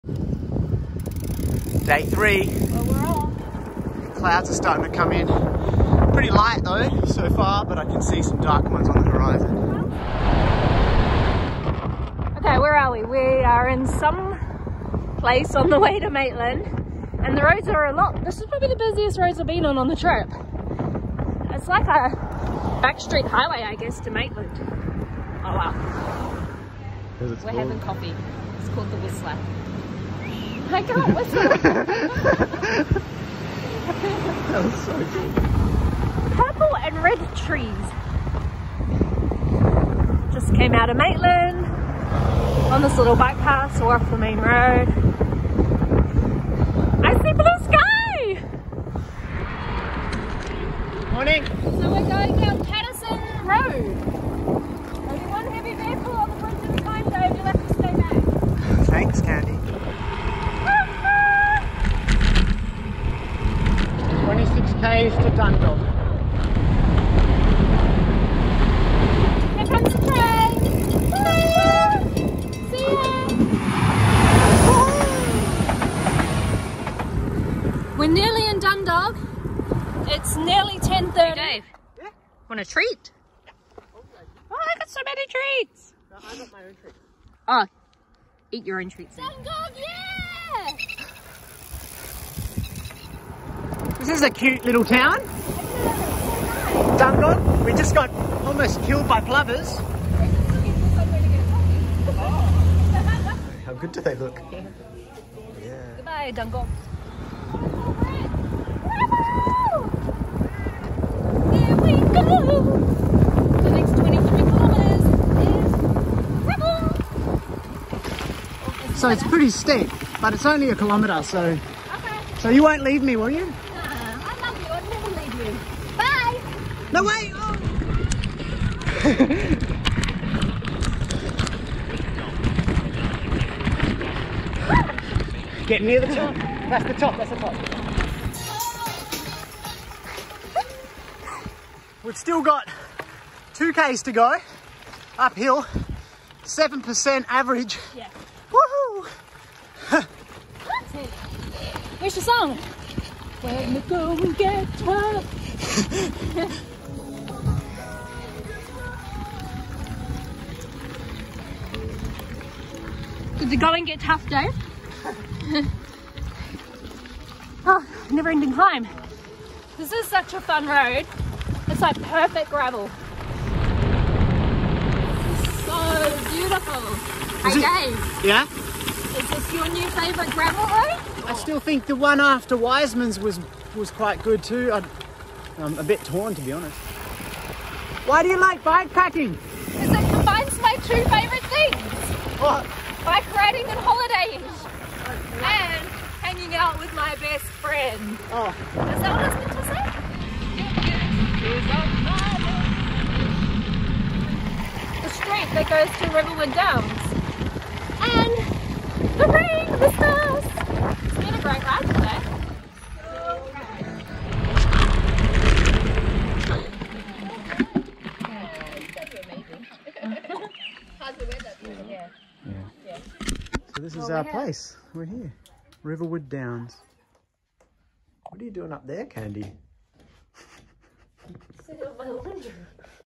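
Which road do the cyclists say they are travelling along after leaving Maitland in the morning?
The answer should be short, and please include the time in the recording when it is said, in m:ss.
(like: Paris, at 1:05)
Paterson Road, at 0:52.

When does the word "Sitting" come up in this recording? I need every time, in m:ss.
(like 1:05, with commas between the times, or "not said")
3:51.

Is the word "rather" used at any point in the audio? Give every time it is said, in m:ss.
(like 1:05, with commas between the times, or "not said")
not said.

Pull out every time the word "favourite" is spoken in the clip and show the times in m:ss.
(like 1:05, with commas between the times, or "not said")
2:59, 3:11.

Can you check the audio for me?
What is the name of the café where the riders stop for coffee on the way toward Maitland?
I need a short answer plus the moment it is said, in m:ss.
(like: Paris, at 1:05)
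The Whistler, at 0:28.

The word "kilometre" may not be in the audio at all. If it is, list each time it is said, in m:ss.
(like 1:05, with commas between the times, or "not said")
2:00.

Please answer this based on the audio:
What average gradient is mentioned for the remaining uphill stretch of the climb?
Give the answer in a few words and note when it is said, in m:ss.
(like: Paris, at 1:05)
7%, at 2:26.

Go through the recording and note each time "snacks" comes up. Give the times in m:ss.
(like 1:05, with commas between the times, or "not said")
not said.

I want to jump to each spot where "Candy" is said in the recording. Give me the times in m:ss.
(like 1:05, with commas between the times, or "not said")
0:59, 3:49.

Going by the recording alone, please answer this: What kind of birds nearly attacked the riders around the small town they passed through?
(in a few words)
Plovers.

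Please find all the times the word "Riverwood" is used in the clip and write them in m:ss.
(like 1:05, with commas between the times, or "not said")
3:26, 3:45.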